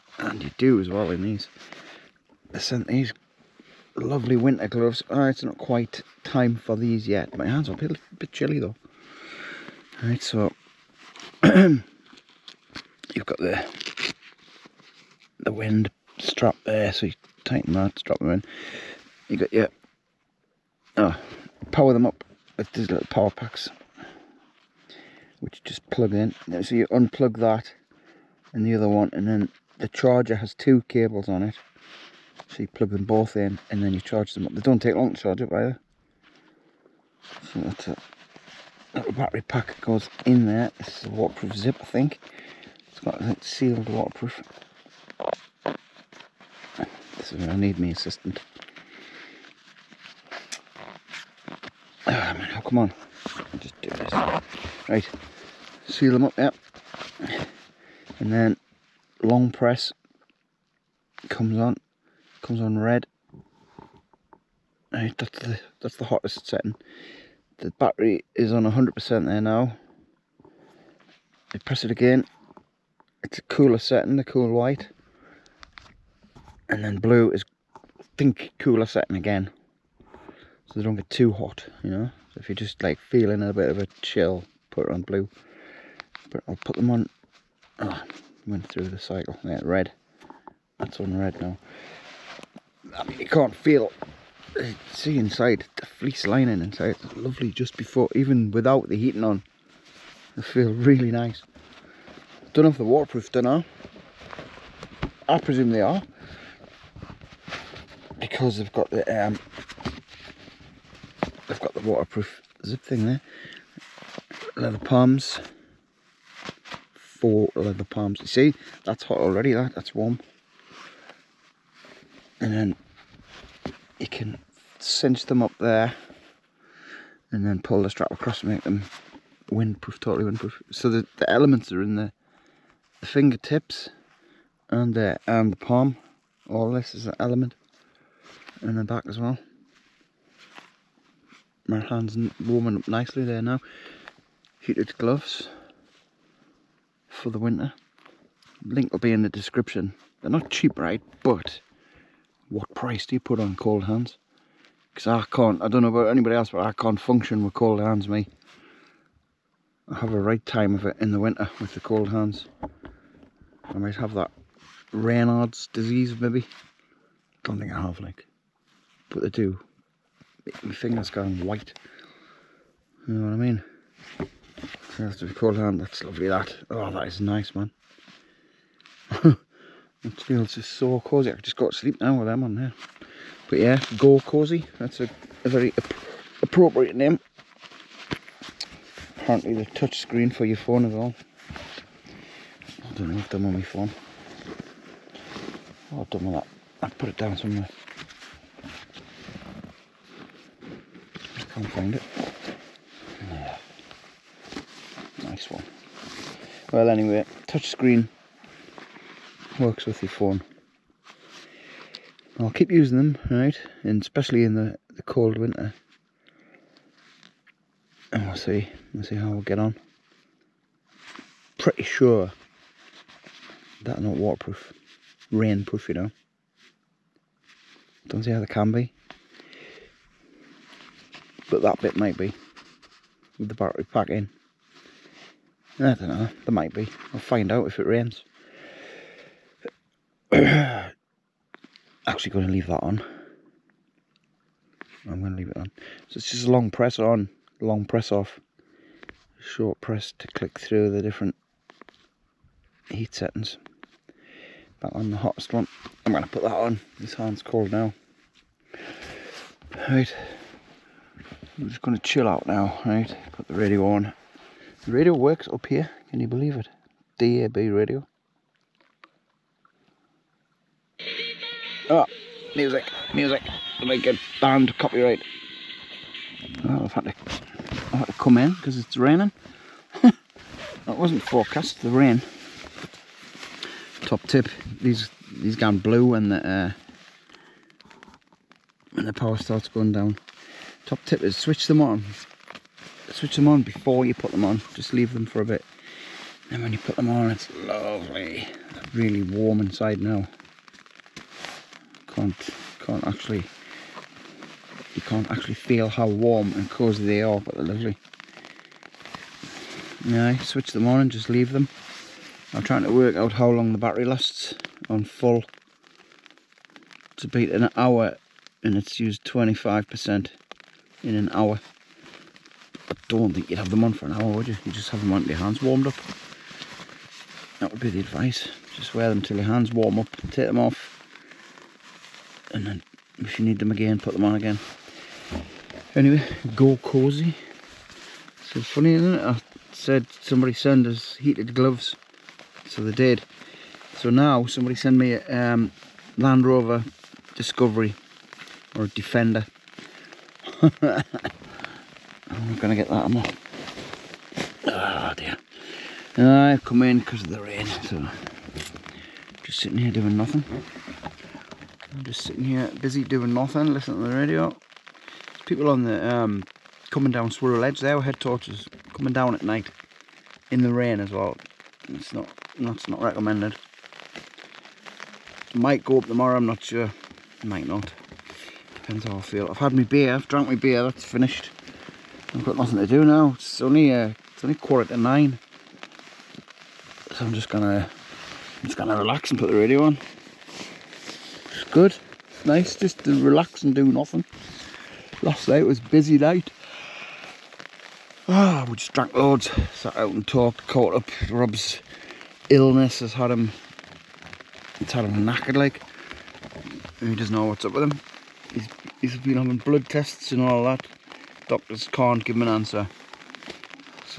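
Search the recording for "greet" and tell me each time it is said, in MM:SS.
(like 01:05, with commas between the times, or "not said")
not said.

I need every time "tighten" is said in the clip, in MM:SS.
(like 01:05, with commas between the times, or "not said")
00:17.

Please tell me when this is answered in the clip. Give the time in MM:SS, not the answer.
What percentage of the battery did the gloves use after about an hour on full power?
05:19.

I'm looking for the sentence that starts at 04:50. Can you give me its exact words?
Top tip is switch them on switch them on before you put them on.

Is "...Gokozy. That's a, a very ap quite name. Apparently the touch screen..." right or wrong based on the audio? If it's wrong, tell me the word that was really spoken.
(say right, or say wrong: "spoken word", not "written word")
wrong: "appropriate", not "quite".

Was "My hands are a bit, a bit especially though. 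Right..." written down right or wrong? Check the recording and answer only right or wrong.
wrong.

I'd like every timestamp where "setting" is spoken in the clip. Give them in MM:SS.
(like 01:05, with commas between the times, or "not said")
01:06, 01:13, 01:18, 04:13.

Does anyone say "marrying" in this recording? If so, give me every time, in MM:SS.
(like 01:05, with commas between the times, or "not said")
not said.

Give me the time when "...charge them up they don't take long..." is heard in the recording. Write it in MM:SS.
00:33.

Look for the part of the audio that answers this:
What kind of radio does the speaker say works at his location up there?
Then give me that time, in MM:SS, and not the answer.
04:27.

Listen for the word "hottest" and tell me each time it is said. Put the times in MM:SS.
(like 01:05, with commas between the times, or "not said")
01:06, 04:15.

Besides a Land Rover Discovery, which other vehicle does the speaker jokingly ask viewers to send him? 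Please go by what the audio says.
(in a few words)
Defender.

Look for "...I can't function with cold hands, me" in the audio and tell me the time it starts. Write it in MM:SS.
02:36.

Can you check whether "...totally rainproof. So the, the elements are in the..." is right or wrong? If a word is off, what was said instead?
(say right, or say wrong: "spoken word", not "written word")
wrong: "windproof", not "rainproof".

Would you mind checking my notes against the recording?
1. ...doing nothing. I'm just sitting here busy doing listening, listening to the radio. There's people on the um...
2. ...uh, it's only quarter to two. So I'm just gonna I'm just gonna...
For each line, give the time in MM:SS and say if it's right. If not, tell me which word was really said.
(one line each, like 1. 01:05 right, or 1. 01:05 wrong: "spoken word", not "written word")
1. 05:59 wrong: "nothing", not "listening"
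2. 06:23 wrong: "nine", not "two".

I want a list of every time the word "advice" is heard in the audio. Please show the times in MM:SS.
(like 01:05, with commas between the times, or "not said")
05:28.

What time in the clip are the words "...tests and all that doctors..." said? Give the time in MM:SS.
06:49.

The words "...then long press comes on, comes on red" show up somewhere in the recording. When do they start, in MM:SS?
00:58.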